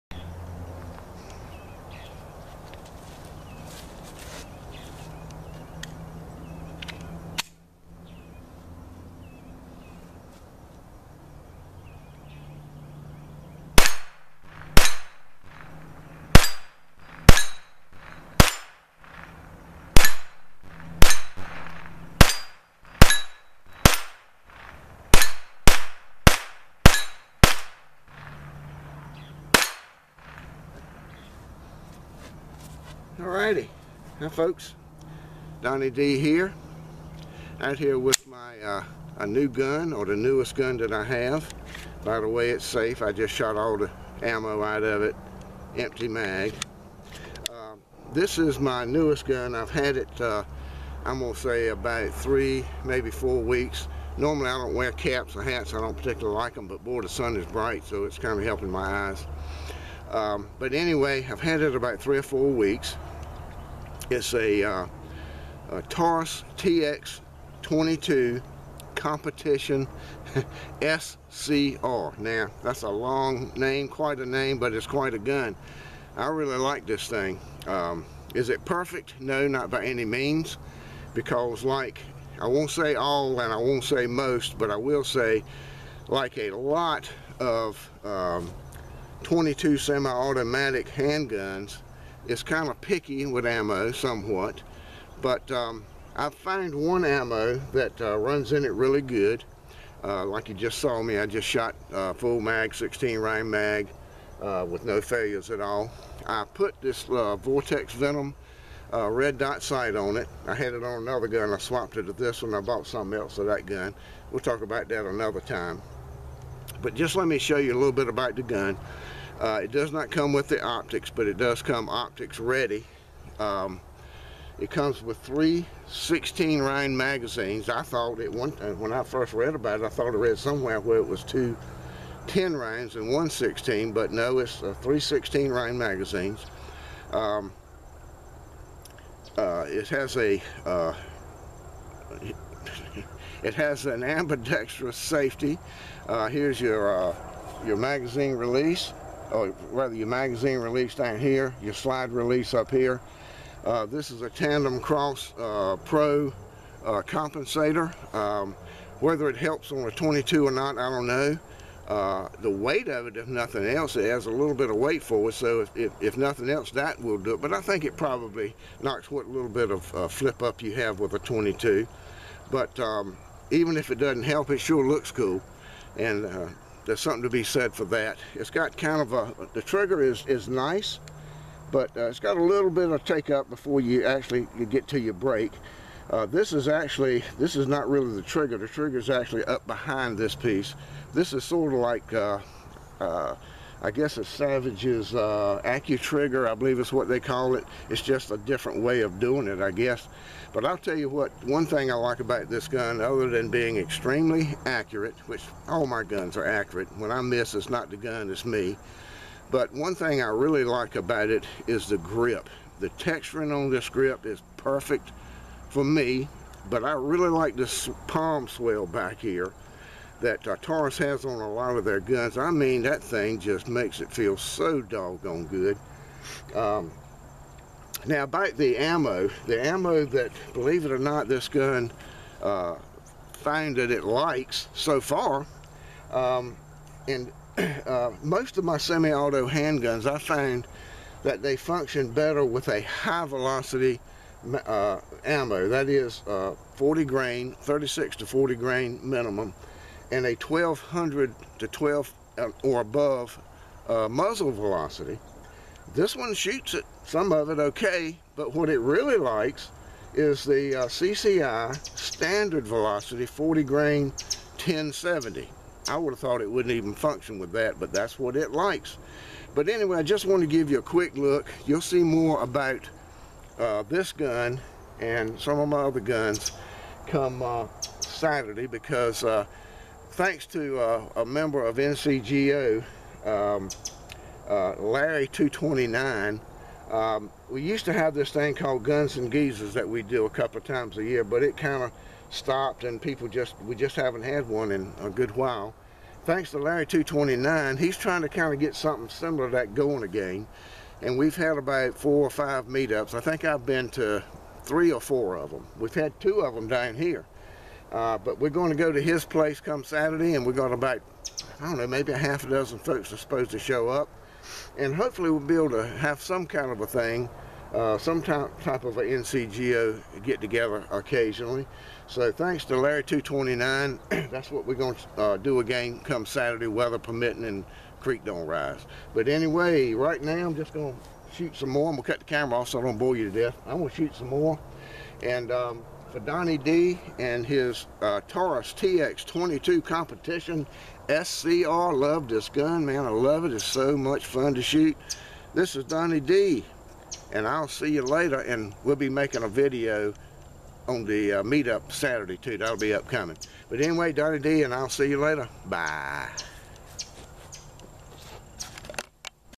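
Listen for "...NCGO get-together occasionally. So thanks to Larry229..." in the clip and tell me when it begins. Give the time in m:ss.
5:19.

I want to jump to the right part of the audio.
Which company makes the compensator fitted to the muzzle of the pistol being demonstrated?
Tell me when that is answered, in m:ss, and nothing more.
2:34.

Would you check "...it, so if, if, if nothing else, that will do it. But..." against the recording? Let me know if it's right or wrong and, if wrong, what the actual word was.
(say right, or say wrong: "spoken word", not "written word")
right.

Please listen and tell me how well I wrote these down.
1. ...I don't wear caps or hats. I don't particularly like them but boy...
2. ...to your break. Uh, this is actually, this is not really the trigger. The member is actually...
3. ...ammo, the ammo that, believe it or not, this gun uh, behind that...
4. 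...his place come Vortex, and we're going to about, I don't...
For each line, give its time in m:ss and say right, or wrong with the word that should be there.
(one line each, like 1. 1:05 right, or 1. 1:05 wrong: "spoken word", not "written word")
1. 0:54 right
2. 3:04 wrong: "trigger", not "member"
3. 3:48 wrong: "found", not "behind"
4. 5:09 wrong: "Saturday", not "Vortex".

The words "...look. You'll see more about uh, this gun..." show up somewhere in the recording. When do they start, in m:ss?
4:31.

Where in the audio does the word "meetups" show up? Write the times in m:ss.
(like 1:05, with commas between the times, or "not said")
5:02, 5:51.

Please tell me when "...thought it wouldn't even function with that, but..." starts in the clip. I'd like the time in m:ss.
4:26.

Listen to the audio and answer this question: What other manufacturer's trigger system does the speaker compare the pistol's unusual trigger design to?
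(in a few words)
AccuTrigger.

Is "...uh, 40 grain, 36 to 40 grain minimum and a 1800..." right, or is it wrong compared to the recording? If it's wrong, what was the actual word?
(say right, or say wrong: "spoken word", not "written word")
wrong: "1200", not "1800".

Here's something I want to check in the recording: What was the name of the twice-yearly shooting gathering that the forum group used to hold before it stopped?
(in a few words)
Guns and Geezers.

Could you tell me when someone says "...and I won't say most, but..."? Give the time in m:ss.
1:23.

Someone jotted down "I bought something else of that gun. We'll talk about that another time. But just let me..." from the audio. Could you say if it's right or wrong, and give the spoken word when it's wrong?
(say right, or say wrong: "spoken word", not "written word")
right.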